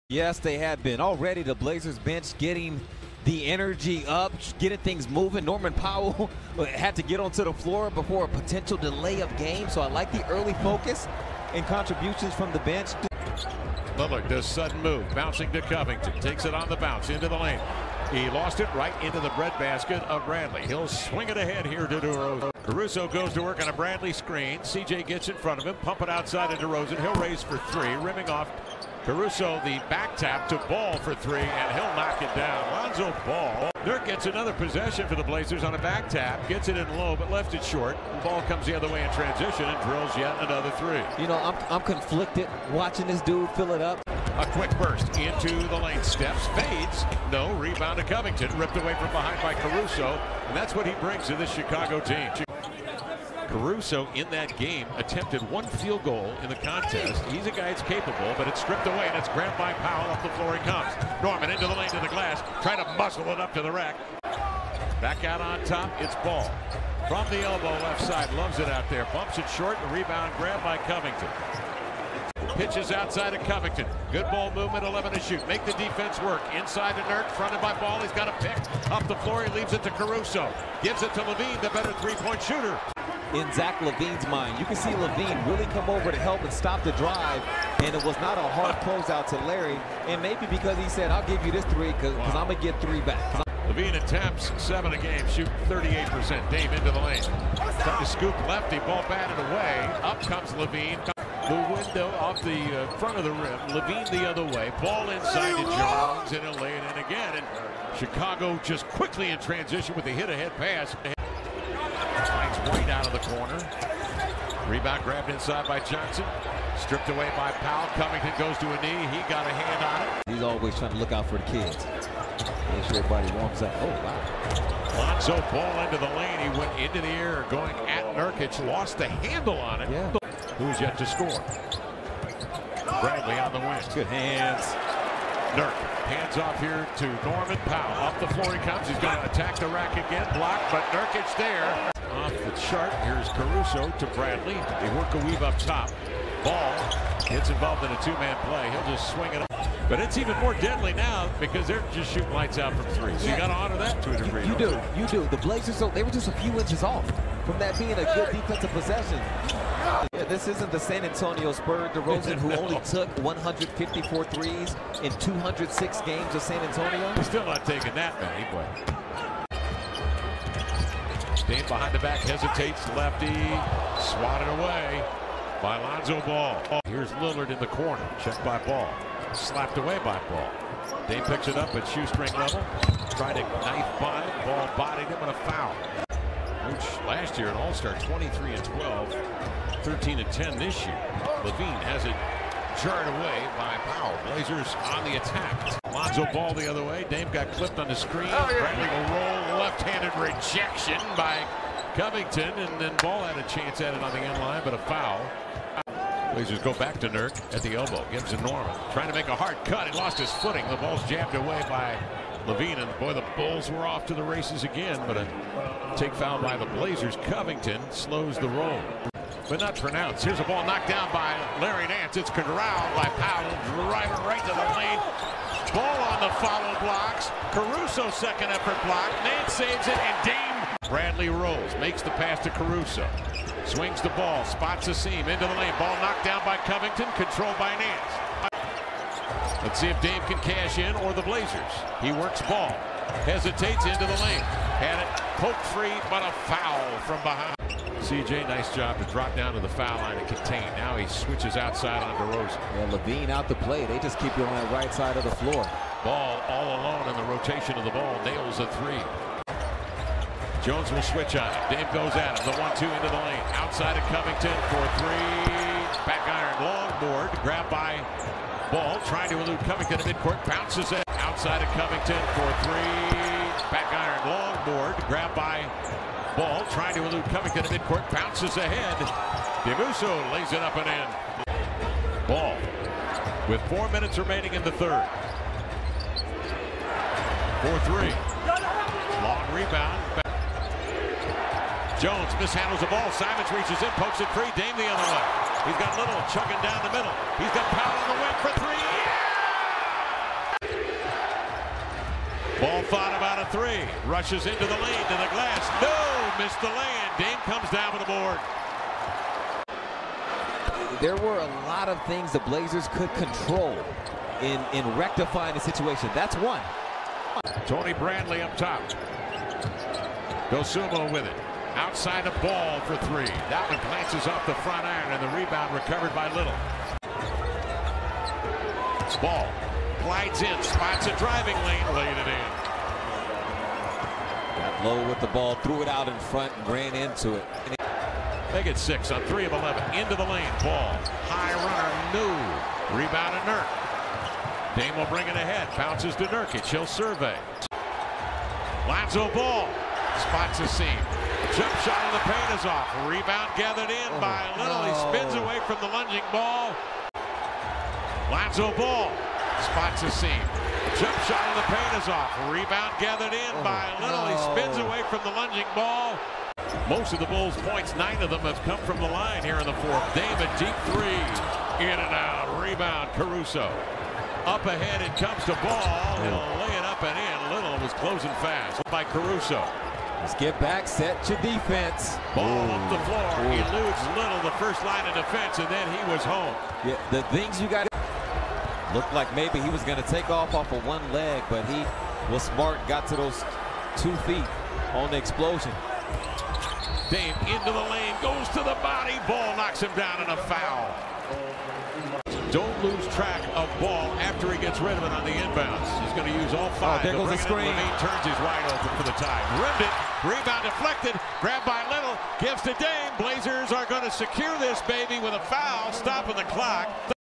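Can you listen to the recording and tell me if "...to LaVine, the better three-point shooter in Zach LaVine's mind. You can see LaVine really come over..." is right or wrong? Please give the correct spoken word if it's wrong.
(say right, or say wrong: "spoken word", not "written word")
right.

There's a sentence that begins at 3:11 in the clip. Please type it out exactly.
LaVine has it Jarred away by Powell.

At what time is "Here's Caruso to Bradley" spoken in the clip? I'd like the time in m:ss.
2:23.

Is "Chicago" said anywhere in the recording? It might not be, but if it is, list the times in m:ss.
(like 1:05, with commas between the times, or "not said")
0:51, 1:47.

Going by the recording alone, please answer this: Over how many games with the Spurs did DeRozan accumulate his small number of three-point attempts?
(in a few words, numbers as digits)
206.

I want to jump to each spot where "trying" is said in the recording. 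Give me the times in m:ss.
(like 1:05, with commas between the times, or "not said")
1:02, 1:37, 2:00, 3:28, 4:29, 4:36.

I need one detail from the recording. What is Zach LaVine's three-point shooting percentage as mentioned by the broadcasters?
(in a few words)
38%.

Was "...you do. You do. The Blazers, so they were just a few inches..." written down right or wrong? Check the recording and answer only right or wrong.
right.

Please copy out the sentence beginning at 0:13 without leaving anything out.
Lillard does sudden move, bouncing to Covington, takes it on the bounce into the lane.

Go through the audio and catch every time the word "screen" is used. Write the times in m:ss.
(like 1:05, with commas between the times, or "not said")
0:24, 3:17, 6:47.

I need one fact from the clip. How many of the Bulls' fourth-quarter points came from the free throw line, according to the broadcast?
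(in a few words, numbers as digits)
9.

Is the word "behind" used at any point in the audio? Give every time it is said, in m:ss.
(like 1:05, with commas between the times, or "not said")
0:49, 2:51, 4:07.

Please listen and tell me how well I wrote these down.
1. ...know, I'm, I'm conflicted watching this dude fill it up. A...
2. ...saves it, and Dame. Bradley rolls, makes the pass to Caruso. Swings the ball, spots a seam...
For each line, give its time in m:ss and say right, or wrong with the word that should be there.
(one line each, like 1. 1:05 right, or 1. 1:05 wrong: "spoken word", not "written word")
1. 0:41 right
2. 3:49 right.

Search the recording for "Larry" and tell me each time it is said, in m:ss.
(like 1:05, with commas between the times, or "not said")
1:29, 3:41.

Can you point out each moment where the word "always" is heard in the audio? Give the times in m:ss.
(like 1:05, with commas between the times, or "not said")
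2:00.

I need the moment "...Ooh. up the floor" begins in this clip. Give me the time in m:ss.
6:22.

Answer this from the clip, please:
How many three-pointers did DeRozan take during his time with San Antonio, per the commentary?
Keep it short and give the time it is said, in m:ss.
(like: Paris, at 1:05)
154, at 2:43.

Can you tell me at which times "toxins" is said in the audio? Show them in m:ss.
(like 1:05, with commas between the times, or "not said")
not said.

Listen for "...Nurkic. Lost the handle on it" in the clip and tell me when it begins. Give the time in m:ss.
2:08.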